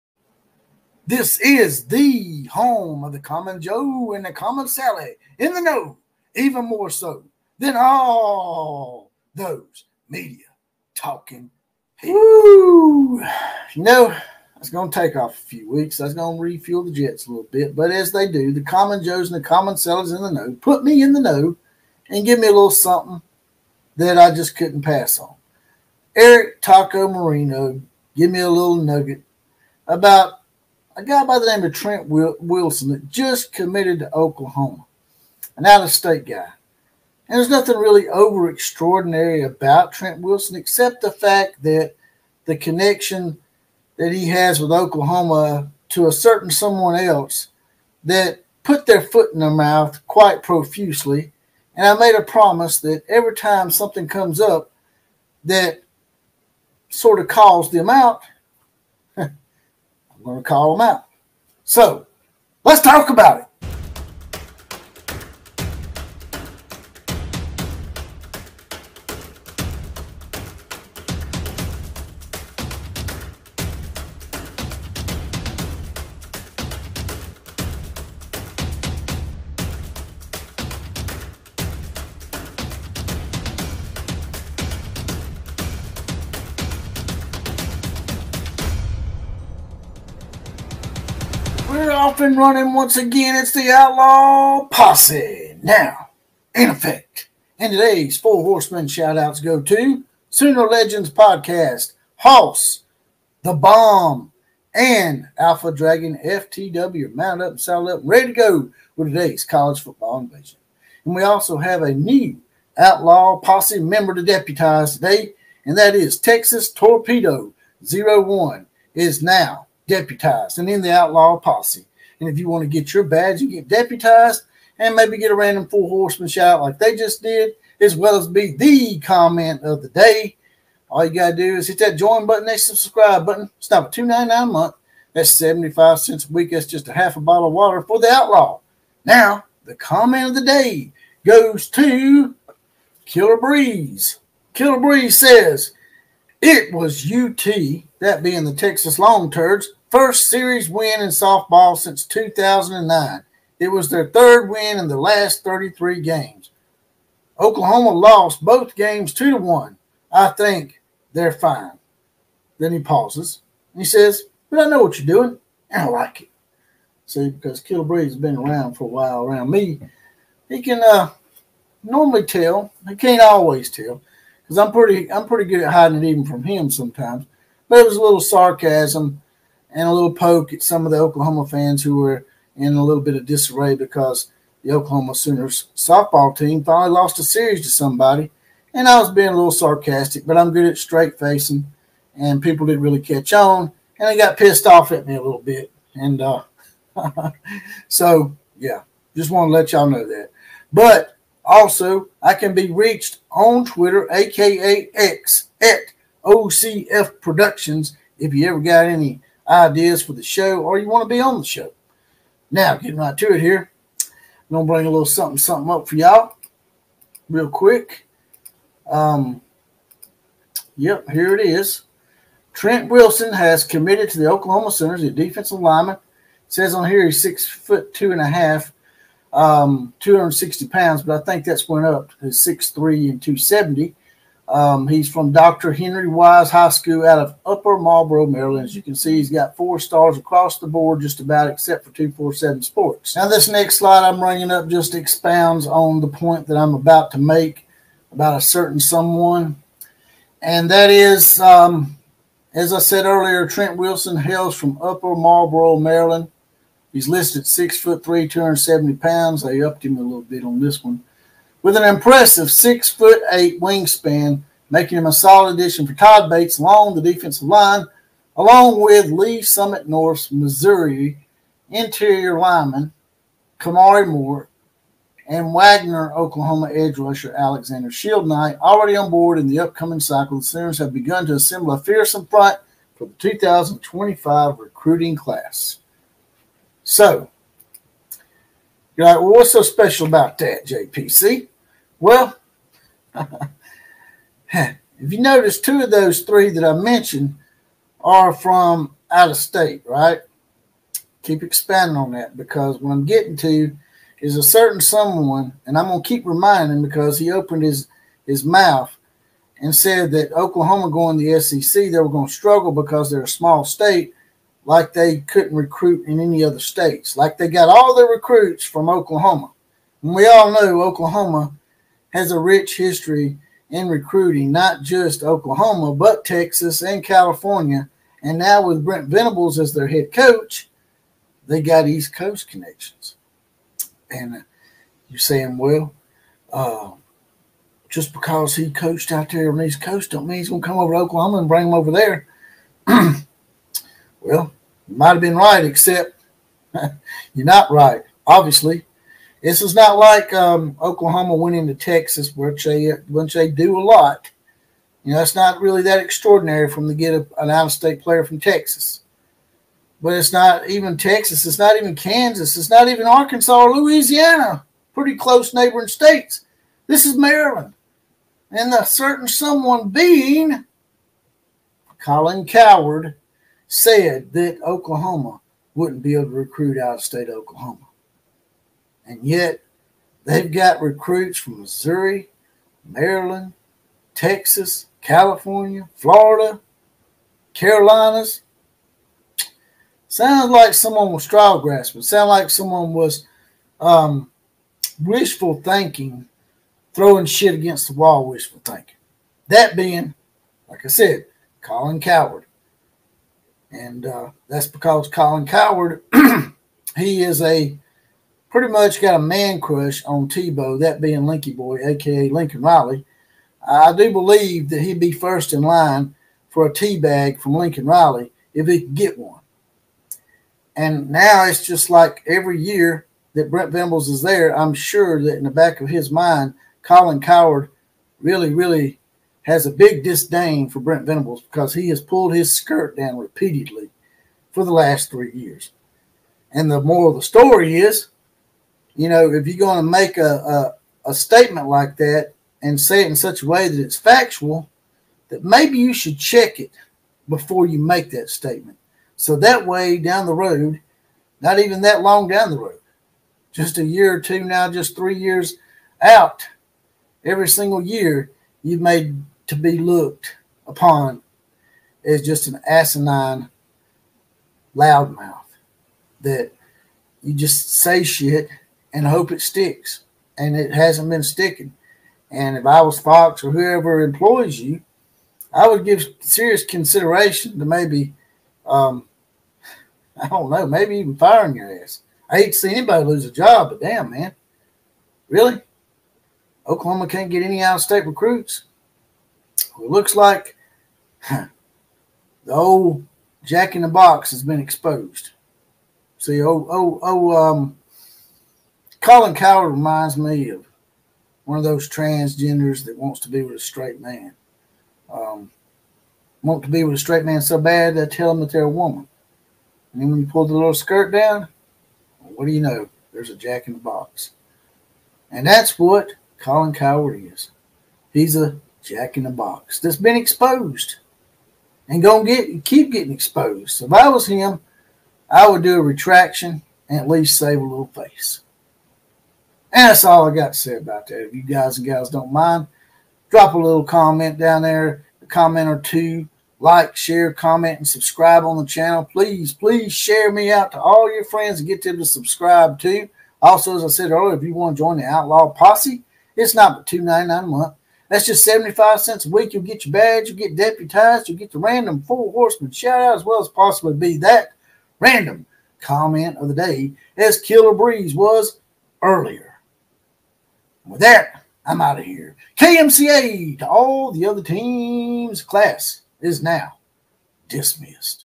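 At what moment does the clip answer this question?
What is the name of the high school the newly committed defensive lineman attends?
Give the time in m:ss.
3:55.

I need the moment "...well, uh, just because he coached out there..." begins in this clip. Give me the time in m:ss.
5:35.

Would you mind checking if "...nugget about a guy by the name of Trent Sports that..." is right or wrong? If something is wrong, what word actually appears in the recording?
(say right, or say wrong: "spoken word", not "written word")
wrong: "Wilson", not "Sports".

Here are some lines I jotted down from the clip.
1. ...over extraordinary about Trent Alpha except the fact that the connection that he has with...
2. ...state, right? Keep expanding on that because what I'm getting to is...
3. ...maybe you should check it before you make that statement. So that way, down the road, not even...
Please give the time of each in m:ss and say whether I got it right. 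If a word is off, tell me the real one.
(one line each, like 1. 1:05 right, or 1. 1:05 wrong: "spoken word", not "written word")
1. 0:38 wrong: "Wilson", not "Alpha"
2. 4:59 right
3. 7:25 right.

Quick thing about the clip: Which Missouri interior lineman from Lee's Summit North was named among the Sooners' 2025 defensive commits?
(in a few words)
Kamari Moore.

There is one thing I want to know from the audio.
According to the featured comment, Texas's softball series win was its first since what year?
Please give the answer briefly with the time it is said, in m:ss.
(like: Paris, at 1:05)
2009, at 2:32.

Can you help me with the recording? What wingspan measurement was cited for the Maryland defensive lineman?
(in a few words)
6 foot 8.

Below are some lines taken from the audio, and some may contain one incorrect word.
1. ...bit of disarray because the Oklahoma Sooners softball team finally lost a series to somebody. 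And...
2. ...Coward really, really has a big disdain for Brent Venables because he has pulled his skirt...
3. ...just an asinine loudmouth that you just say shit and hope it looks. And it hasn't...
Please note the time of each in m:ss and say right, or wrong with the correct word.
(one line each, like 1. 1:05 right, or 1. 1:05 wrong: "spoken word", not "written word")
1. 3:03 right
2. 7:07 right
3. 7:42 wrong: "sticks", not "looks".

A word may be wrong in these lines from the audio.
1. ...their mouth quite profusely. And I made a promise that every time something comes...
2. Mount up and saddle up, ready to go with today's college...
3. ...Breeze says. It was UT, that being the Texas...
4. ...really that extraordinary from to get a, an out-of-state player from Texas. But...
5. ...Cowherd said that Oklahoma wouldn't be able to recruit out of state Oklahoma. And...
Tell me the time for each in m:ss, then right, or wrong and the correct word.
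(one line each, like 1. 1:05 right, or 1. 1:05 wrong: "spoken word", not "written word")
1. 0:49 right
2. 1:47 right
3. 2:24 right
4. 5:55 right
5. 6:12 right.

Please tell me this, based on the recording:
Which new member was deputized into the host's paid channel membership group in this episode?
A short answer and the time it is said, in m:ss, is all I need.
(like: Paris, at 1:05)
Texas Torpedo 01, at 1:56.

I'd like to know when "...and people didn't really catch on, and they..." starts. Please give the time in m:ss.
3:12.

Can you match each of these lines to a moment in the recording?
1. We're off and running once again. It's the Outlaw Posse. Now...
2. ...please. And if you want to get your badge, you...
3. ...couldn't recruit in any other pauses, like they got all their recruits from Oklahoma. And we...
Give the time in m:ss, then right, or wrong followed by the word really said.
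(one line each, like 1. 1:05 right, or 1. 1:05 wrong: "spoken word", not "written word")
1. 1:31 right
2. 2:01 wrong: "posse", not "please"
3. 5:15 wrong: "states", not "pauses".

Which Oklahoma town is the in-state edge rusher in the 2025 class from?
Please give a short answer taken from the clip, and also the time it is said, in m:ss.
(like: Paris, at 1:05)
Wagoner, at 4:35.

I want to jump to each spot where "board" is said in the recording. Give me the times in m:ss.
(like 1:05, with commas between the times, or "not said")
4:00, 4:39.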